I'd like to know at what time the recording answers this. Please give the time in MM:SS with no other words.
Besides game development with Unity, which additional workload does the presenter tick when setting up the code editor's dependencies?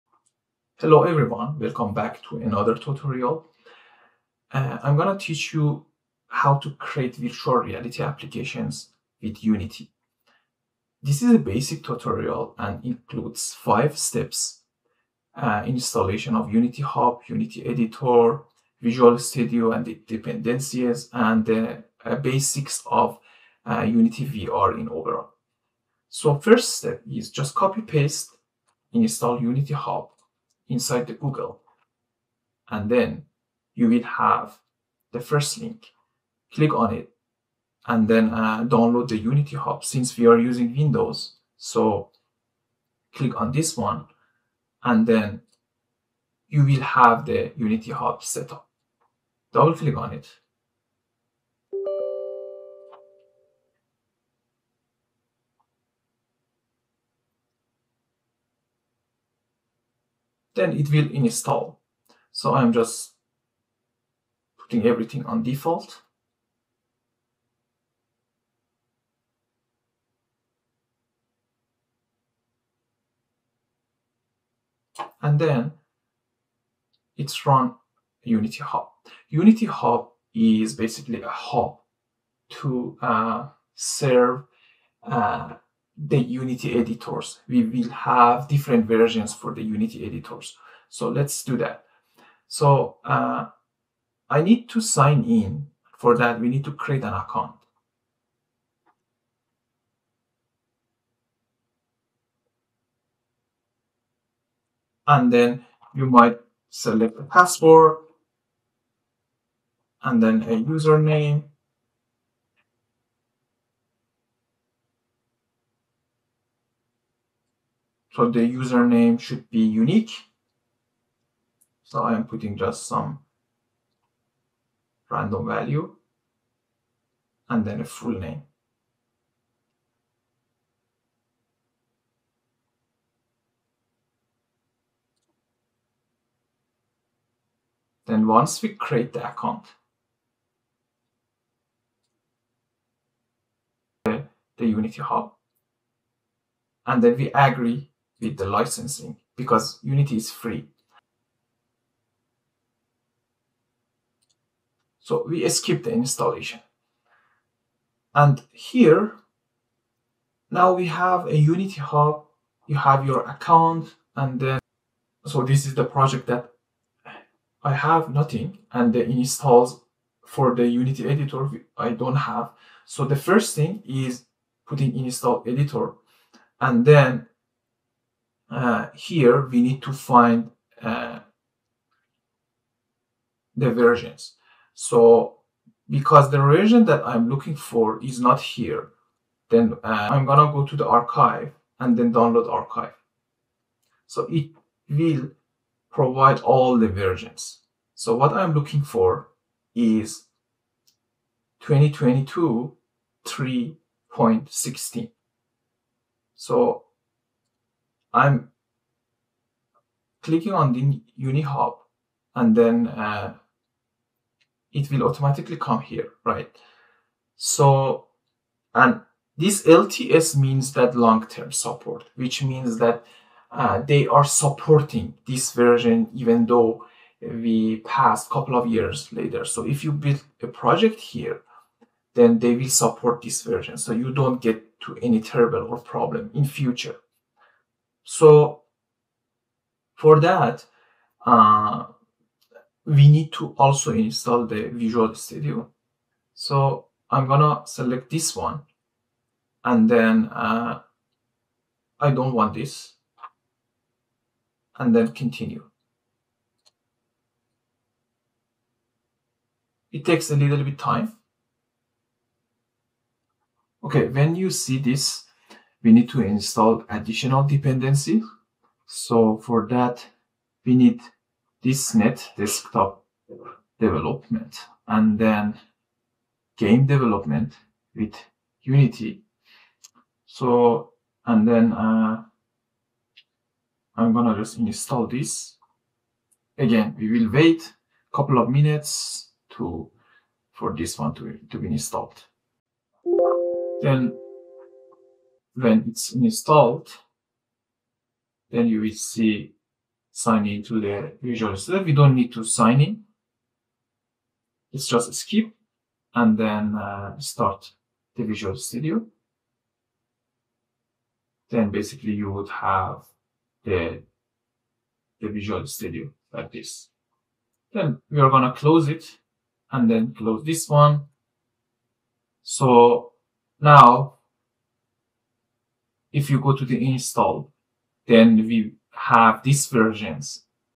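04:31.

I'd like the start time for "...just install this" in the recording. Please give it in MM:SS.
04:44.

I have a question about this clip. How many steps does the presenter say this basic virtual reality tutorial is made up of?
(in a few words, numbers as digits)
5.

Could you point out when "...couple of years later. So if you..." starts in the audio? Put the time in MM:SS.
03:48.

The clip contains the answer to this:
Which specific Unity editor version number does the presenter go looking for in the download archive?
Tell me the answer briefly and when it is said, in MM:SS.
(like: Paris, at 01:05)
2022 3.16, at 03:21.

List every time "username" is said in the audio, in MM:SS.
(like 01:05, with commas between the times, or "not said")
01:50, 01:58.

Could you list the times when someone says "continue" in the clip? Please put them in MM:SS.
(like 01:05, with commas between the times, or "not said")
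04:15.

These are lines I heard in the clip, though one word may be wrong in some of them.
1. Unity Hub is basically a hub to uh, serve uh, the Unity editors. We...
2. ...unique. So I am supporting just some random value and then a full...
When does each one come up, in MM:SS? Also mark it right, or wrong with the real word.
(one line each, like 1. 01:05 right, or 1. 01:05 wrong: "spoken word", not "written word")
1. 01:19 right
2. 01:59 wrong: "putting", not "supporting".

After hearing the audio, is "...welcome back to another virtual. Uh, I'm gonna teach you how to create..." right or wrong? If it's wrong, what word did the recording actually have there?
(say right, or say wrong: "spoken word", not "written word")
wrong: "tutorial", not "virtual".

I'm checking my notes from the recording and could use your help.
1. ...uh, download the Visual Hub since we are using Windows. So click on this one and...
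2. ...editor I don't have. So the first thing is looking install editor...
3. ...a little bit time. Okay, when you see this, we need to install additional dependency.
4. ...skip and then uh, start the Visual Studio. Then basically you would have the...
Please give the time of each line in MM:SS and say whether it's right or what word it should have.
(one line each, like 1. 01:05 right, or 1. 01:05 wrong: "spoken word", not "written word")
1. 00:38 wrong: "Unity", not "Visual"
2. 02:51 wrong: "putting", not "looking"
3. 04:20 right
4. 05:05 right.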